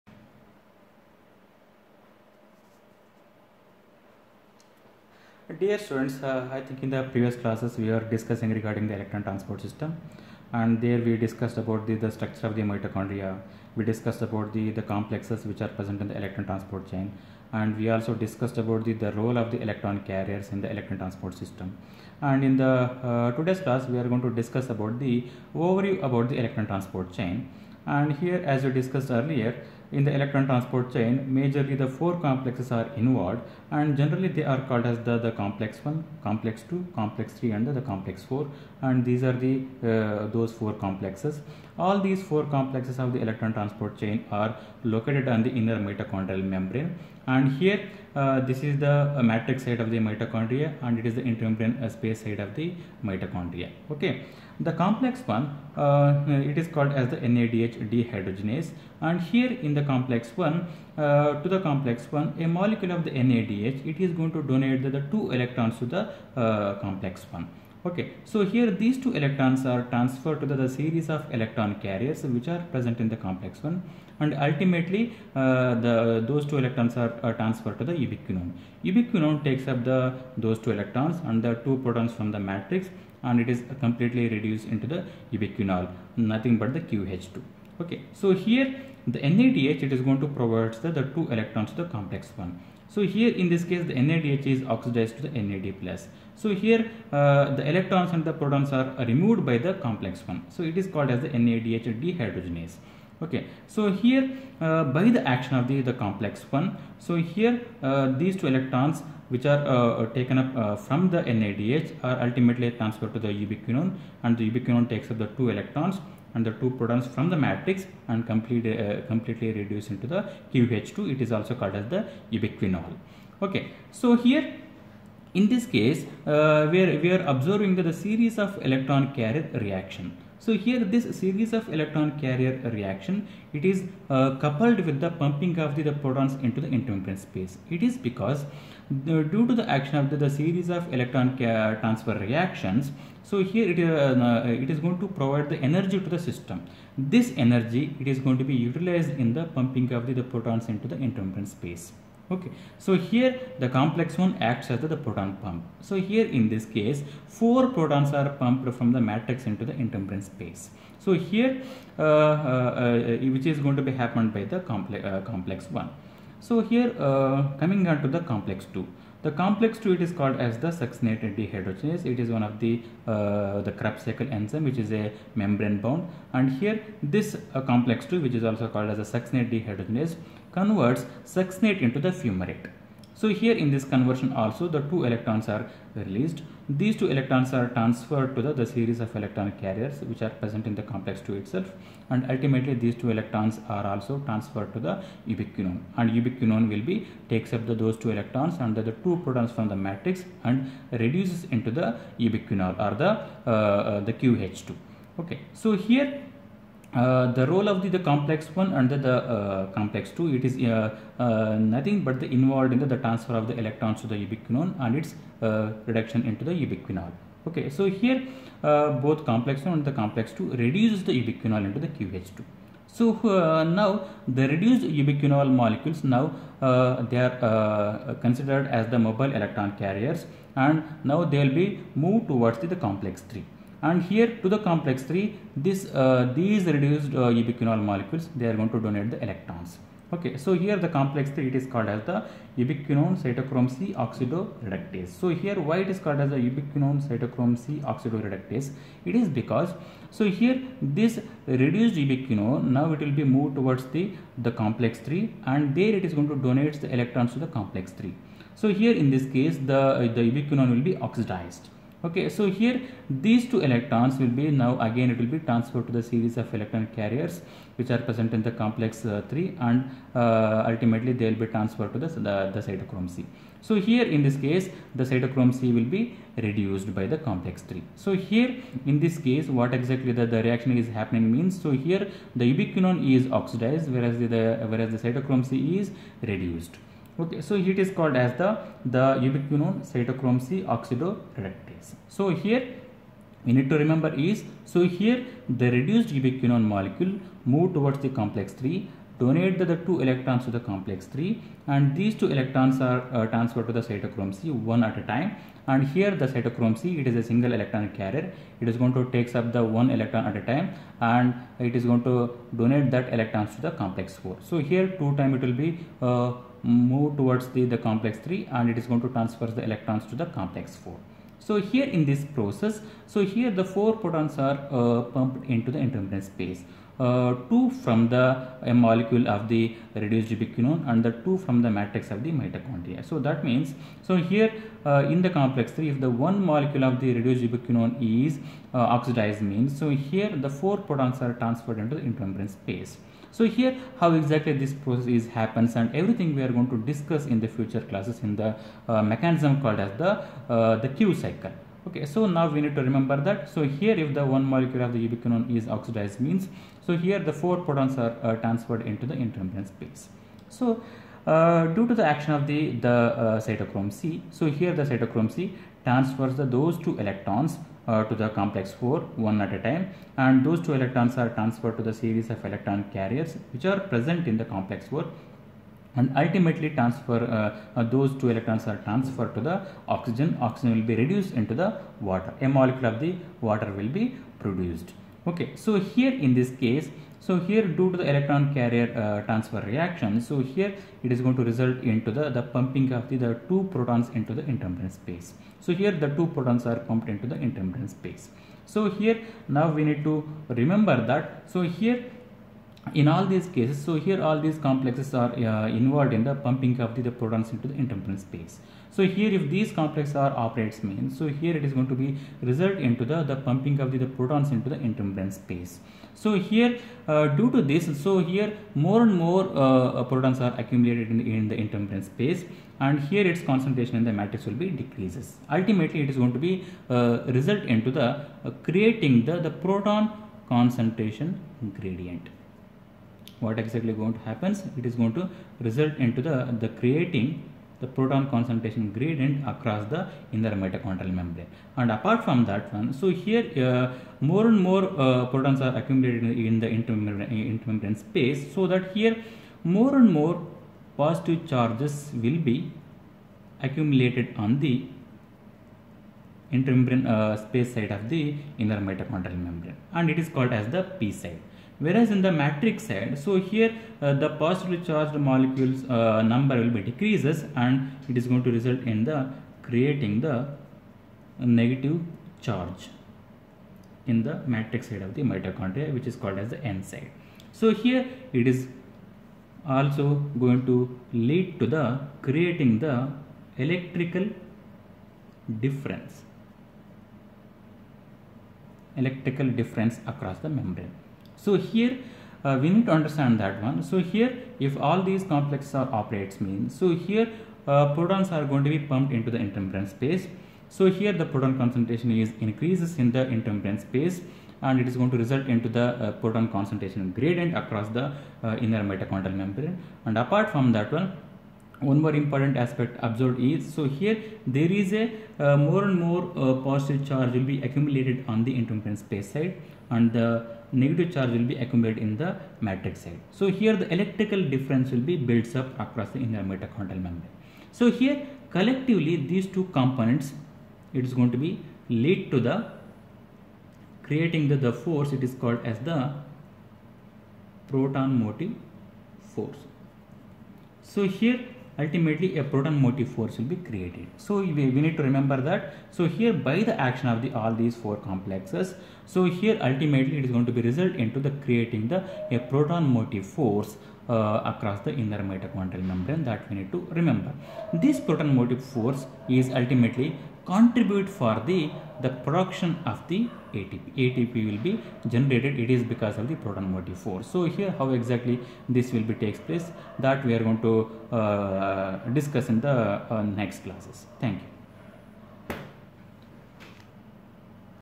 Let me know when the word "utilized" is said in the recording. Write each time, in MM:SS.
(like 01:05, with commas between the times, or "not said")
02:28.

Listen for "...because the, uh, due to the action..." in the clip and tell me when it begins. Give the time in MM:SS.
02:17.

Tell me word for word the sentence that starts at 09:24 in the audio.
ATP will be generated, it is because of the proton motive force.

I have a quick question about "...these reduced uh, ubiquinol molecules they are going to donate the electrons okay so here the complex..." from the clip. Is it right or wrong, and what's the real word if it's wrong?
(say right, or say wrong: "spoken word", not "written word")
right.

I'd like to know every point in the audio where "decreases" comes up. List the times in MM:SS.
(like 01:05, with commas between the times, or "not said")
07:04, 07:46.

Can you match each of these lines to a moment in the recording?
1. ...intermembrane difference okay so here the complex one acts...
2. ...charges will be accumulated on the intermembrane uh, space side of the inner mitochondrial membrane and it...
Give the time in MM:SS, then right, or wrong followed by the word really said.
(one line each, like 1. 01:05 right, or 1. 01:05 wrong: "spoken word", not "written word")
1. 02:30 wrong: "space", not "difference"
2. 07:31 right.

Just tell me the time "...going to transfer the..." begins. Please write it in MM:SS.
05:18.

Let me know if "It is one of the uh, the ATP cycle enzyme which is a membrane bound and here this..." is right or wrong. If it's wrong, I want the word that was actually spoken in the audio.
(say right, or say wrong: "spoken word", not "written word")
wrong: "Krebs", not "ATP".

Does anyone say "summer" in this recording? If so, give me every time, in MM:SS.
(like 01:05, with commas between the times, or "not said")
not said.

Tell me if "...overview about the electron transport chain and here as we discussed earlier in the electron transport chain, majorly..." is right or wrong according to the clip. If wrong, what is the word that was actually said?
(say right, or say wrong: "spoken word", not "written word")
right.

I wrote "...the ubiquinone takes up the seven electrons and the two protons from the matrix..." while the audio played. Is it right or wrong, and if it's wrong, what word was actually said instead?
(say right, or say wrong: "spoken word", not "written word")
wrong: "two", not "seven".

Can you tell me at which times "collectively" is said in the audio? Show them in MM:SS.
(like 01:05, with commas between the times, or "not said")
08:48.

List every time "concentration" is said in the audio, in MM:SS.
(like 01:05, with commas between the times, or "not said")
07:03, 07:10, 07:18, 08:21, 08:26.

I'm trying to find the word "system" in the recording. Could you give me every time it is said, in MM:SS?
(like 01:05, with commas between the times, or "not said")
00:09, 00:21, 02:26.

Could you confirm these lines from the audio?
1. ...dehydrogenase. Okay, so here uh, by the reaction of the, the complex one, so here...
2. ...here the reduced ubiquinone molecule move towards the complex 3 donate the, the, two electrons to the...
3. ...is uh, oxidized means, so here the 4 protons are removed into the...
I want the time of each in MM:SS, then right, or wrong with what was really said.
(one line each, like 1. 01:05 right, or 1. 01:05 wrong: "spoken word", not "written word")
1. 01:42 wrong: "action", not "reaction"
2. 04:54 right
3. 05:38 wrong: "transferred", not "removed".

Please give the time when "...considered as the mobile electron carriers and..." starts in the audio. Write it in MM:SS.
03:48.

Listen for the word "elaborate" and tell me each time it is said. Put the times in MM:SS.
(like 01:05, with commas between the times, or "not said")
not said.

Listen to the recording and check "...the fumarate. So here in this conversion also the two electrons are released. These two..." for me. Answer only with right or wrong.
right.